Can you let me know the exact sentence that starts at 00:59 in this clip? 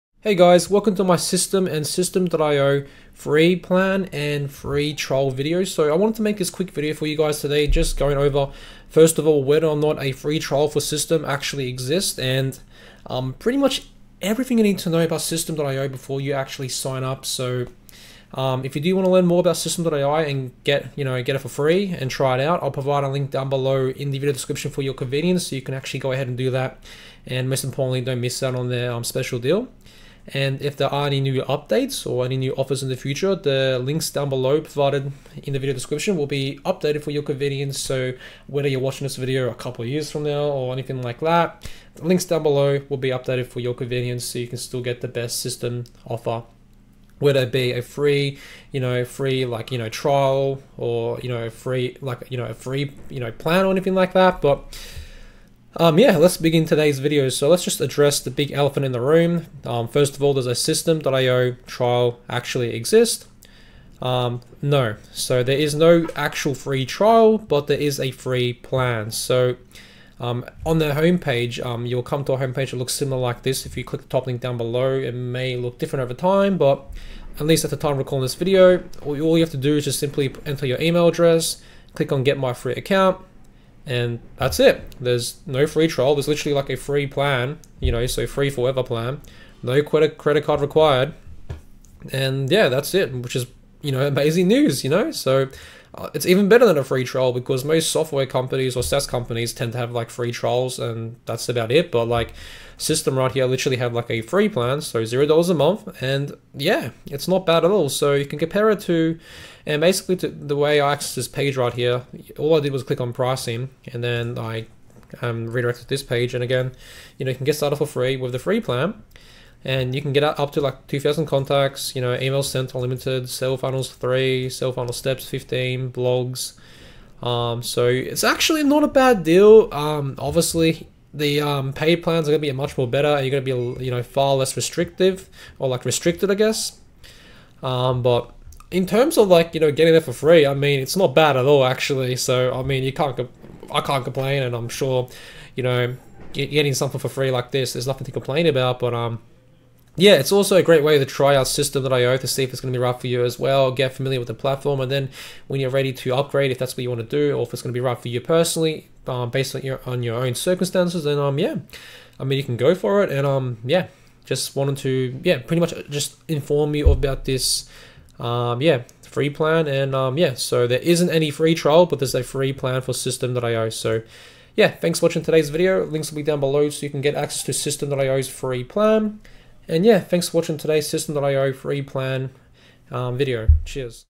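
Um, first of all, does a systeme.io trial actually exist?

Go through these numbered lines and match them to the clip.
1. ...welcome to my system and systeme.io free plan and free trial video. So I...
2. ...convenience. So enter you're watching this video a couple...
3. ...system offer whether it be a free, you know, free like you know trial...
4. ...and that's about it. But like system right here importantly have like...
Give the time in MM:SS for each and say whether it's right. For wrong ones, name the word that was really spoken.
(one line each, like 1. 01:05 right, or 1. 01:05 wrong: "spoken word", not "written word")
1. 00:00 right
2. 00:37 wrong: "whether", not "enter"
3. 00:45 right
4. 01:40 wrong: "literally", not "importantly".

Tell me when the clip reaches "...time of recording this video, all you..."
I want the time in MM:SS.
01:17.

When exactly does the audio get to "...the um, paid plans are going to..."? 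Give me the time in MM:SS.
02:11.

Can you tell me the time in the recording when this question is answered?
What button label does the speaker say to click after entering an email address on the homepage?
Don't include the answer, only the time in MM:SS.
01:22.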